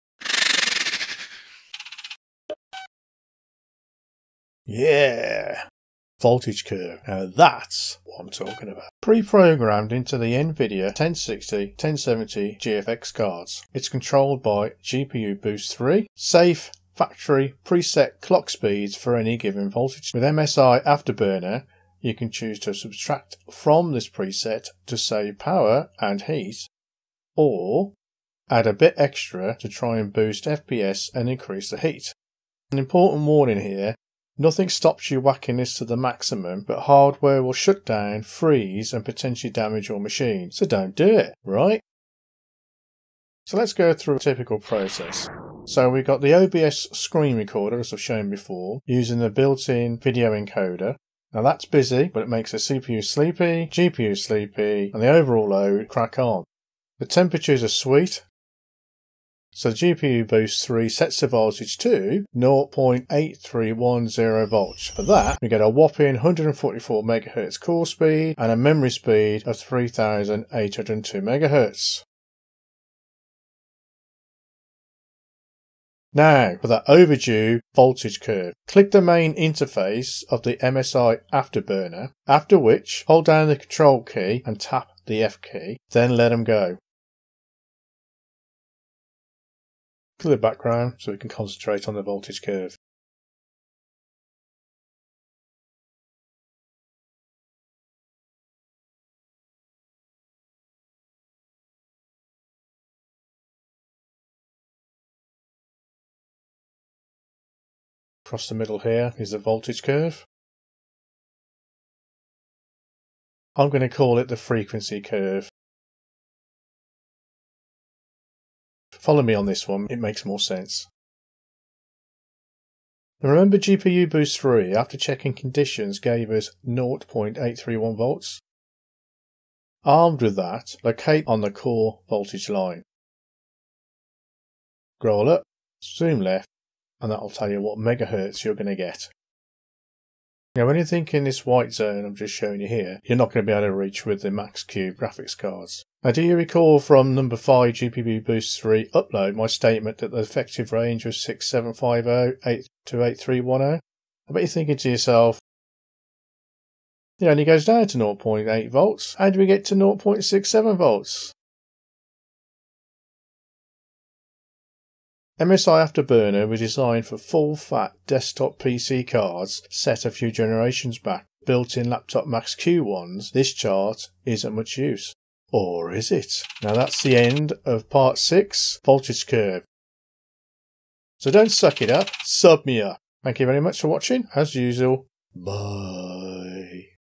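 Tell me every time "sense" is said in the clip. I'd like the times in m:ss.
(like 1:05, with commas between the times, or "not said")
2:00.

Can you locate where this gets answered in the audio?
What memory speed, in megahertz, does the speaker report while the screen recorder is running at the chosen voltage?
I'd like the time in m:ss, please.
1:09.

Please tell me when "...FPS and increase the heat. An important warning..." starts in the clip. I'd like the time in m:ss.
0:30.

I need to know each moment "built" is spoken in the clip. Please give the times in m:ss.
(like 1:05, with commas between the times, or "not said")
0:49, 2:51.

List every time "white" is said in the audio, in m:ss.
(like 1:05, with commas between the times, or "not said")
2:21.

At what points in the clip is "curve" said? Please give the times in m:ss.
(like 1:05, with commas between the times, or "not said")
0:06, 1:18, 1:32, 1:49, 1:55, 2:59.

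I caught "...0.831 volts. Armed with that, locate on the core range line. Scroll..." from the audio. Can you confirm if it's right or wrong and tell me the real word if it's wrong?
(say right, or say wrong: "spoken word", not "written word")
wrong: "voltage", not "range".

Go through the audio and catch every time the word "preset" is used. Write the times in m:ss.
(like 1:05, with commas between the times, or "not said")
0:17, 0:24.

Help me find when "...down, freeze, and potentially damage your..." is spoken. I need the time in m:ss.
0:37.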